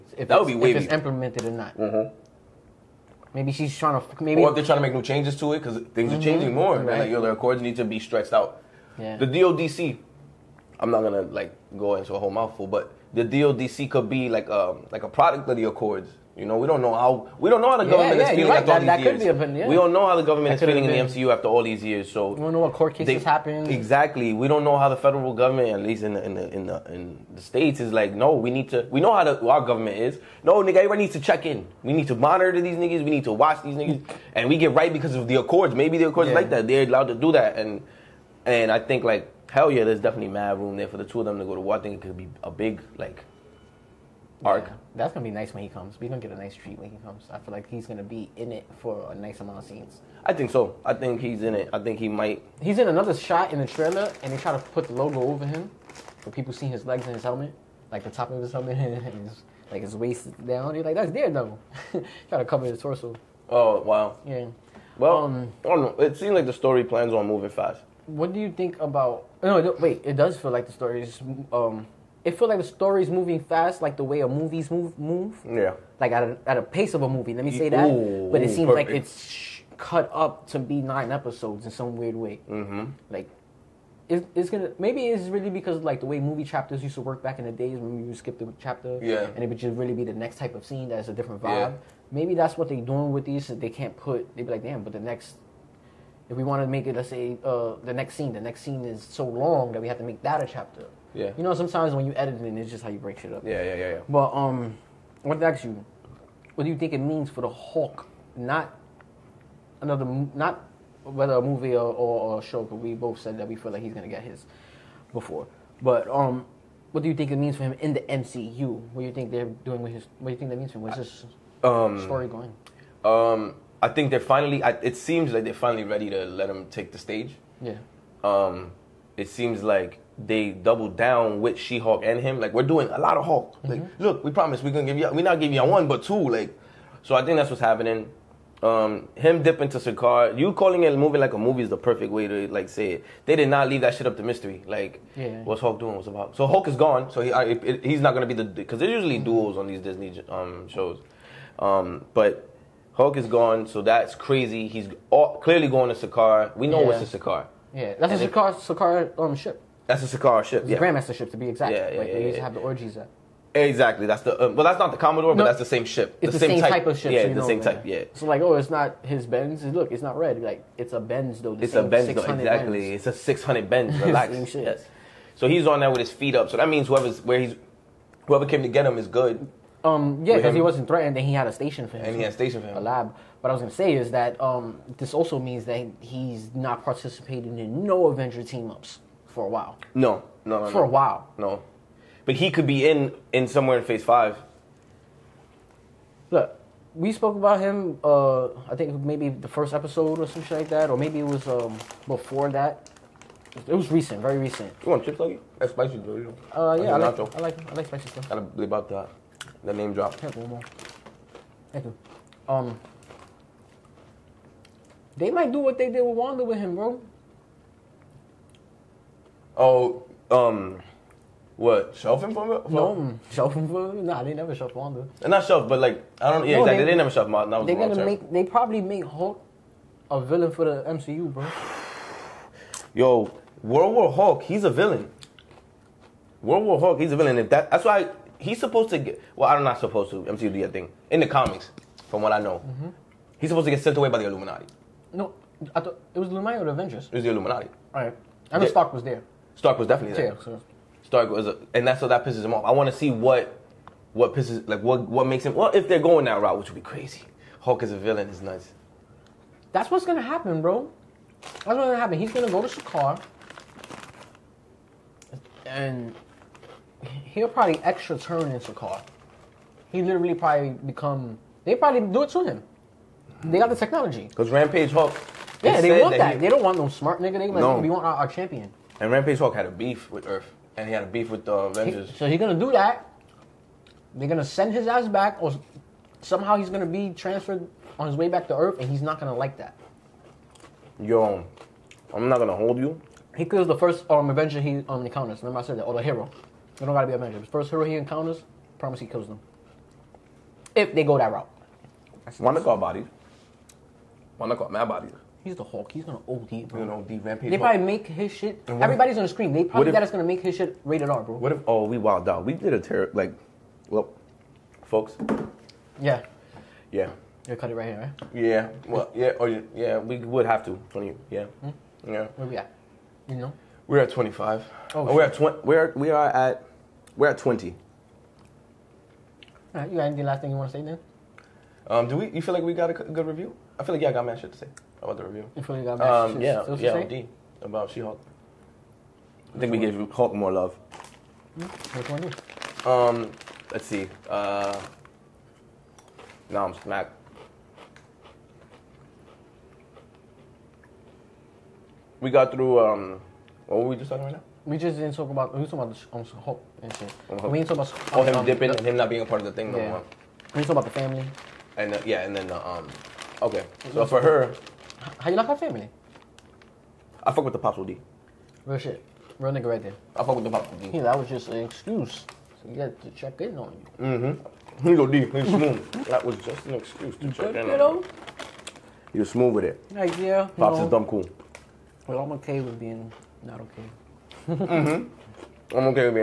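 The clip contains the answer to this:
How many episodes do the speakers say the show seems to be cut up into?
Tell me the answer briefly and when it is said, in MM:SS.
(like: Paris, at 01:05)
9, at 01:20.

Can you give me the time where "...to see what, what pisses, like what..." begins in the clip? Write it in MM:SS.
04:12.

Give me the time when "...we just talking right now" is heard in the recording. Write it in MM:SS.
05:53.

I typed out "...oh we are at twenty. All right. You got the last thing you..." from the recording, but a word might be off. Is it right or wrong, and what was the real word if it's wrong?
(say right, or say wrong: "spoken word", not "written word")
right.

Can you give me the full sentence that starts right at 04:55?
Remember I said that, or the hero.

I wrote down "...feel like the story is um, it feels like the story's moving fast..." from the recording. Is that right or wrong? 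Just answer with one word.
right.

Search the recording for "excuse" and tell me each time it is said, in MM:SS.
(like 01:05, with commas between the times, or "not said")
06:11, 06:16.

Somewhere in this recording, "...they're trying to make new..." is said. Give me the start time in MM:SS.
00:04.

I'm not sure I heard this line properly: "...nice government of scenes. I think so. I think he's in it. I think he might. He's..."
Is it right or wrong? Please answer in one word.
wrong.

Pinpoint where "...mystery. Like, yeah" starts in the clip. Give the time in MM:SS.
02:24.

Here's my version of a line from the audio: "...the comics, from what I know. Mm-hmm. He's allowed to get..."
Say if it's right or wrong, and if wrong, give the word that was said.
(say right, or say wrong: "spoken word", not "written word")
wrong: "supposed", not "allowed".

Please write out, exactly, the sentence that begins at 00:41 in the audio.
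I think it could be a big like arc.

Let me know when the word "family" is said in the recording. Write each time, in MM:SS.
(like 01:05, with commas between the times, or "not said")
06:00, 06:05.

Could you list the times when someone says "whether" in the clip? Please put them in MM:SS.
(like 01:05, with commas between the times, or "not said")
01:51.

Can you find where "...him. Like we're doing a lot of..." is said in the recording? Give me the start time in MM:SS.
02:12.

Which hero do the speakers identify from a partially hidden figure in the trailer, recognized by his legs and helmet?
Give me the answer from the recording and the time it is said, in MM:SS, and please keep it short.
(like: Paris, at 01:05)
Daredevil, at 01:01.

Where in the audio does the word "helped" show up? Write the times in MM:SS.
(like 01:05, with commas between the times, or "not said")
not said.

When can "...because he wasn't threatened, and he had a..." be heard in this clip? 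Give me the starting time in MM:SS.
03:00.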